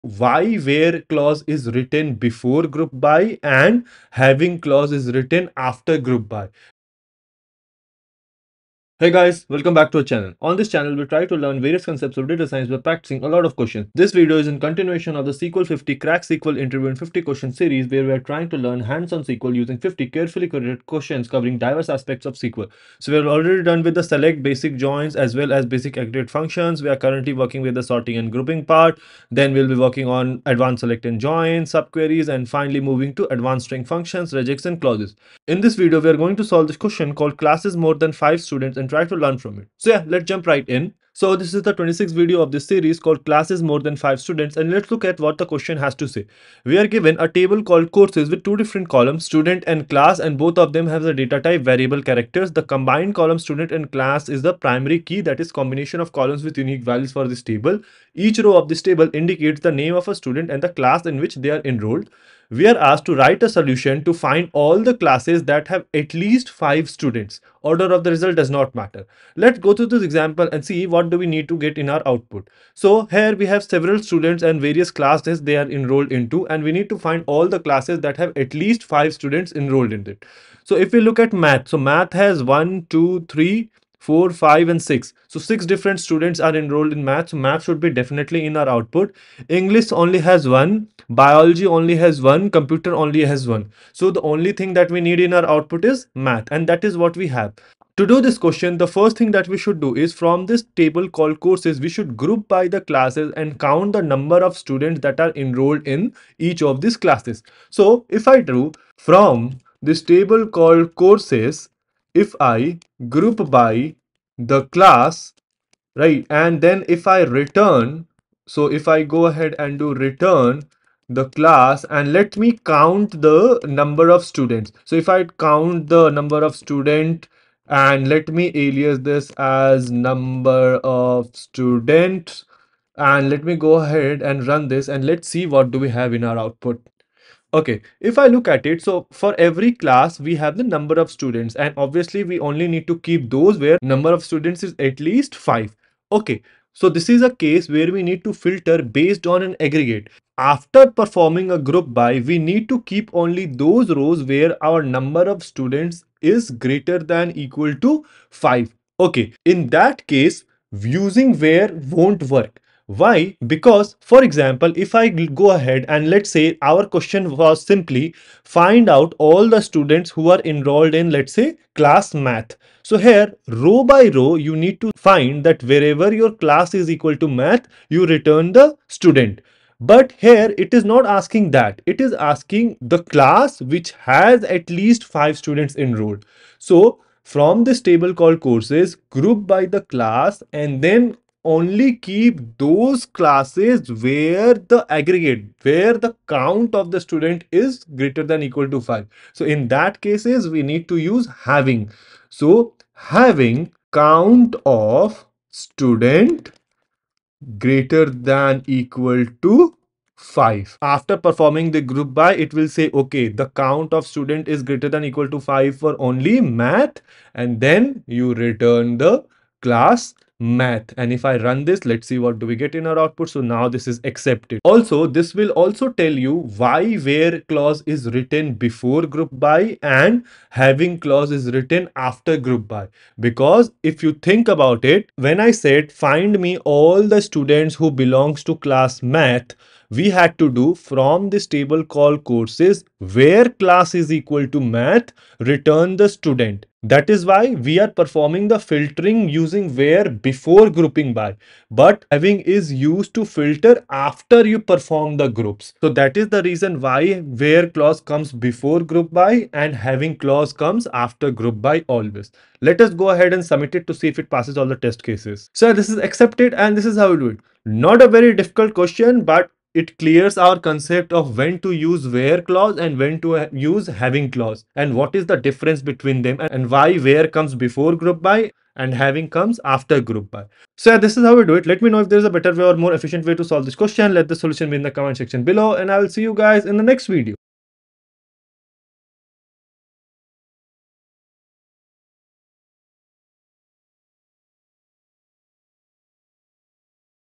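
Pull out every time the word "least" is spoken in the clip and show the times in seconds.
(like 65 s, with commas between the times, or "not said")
66 s, 78 s, 145 s, 184 s.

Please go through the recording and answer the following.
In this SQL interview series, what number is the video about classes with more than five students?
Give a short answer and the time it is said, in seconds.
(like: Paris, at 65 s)
26th, at 41 s.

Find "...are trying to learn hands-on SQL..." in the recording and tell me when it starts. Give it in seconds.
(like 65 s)
18 s.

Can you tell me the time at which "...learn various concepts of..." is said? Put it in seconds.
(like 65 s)
11 s.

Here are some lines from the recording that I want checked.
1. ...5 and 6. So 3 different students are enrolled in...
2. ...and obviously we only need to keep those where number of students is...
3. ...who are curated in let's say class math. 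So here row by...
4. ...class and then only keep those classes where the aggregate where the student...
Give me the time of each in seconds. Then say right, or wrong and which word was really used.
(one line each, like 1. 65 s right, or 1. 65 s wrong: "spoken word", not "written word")
1. 84 s wrong: "6", not "3"
2. 141 s right
3. 170 s wrong: "enrolled", not "curated"
4. 189 s wrong: "count", not "student".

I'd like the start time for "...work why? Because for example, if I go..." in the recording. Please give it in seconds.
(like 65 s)
162 s.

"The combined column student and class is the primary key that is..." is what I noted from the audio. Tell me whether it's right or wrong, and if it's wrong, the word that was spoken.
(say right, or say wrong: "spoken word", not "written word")
right.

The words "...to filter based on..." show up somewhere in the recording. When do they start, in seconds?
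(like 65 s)
148 s.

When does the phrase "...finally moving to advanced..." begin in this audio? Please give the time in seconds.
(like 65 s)
32 s.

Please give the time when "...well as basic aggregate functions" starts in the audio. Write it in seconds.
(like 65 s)
25 s.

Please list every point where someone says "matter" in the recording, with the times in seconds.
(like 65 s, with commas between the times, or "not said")
68 s.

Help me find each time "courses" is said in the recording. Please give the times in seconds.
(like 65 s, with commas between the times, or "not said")
47 s, 101 s, 110 s, 188 s, 242 s.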